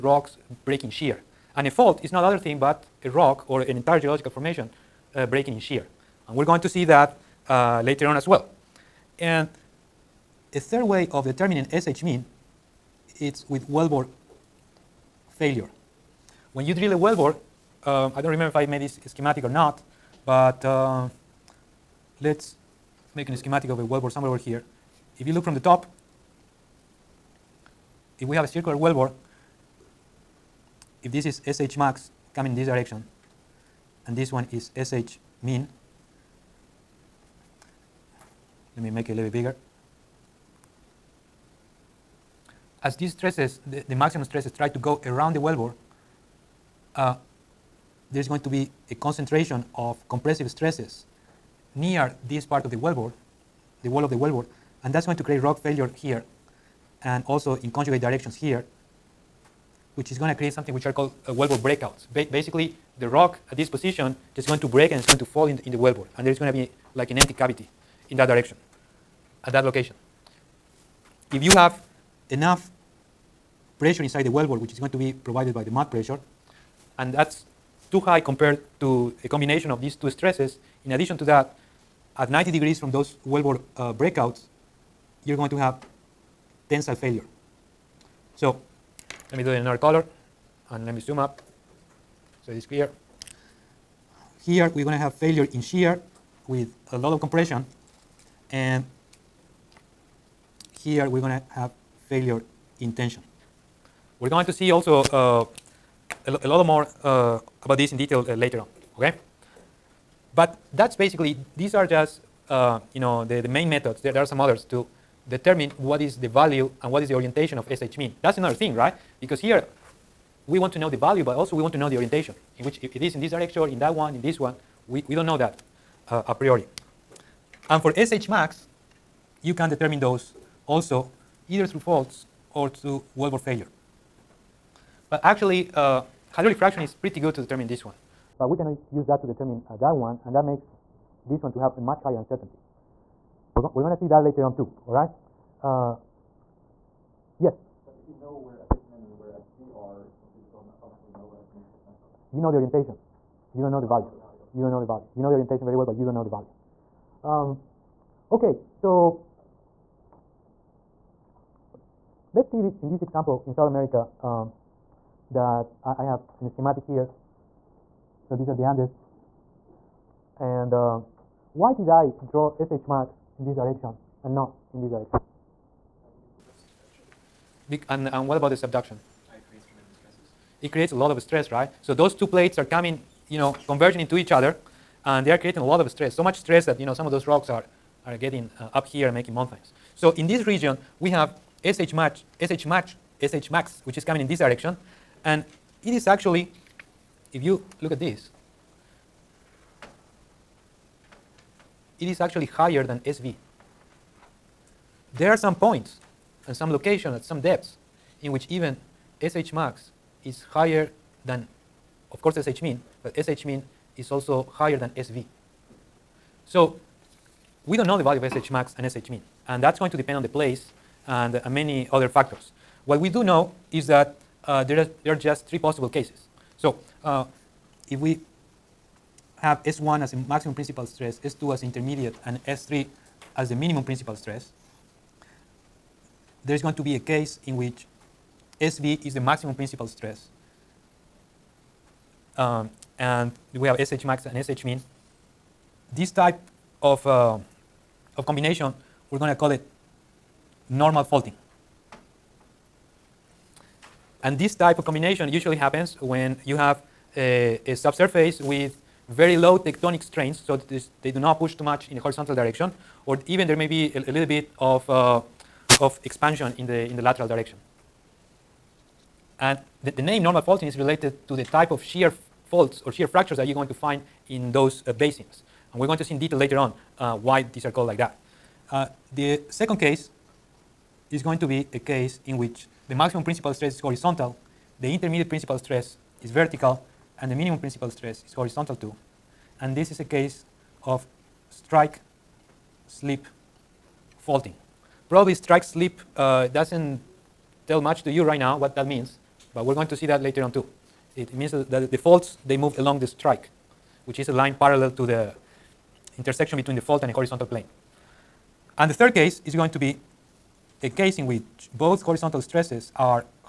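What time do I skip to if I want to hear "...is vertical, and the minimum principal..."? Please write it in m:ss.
4:46.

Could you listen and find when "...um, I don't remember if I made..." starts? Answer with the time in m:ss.
0:17.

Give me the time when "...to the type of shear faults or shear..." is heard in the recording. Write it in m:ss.
4:31.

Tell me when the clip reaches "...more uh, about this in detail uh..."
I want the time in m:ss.
1:46.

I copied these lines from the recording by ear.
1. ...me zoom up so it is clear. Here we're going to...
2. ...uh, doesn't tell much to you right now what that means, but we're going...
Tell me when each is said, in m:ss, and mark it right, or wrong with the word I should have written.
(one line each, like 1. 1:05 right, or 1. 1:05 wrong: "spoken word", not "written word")
1. 1:30 right
2. 4:56 right.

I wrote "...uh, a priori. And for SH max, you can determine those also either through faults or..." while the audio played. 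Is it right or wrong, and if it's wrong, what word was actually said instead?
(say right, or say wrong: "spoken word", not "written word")
right.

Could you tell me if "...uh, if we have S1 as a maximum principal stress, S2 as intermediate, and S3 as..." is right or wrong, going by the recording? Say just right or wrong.
right.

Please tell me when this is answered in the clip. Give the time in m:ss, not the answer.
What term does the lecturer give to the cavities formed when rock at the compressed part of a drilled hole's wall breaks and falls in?
1:01.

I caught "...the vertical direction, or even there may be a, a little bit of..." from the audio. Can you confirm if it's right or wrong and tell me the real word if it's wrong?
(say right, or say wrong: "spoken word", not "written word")
wrong: "horizontal", not "vertical".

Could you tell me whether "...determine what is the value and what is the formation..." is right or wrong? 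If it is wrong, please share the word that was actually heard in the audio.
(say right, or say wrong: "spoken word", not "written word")
wrong: "orientation", not "formation".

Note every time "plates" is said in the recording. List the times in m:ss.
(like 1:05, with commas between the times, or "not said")
3:02.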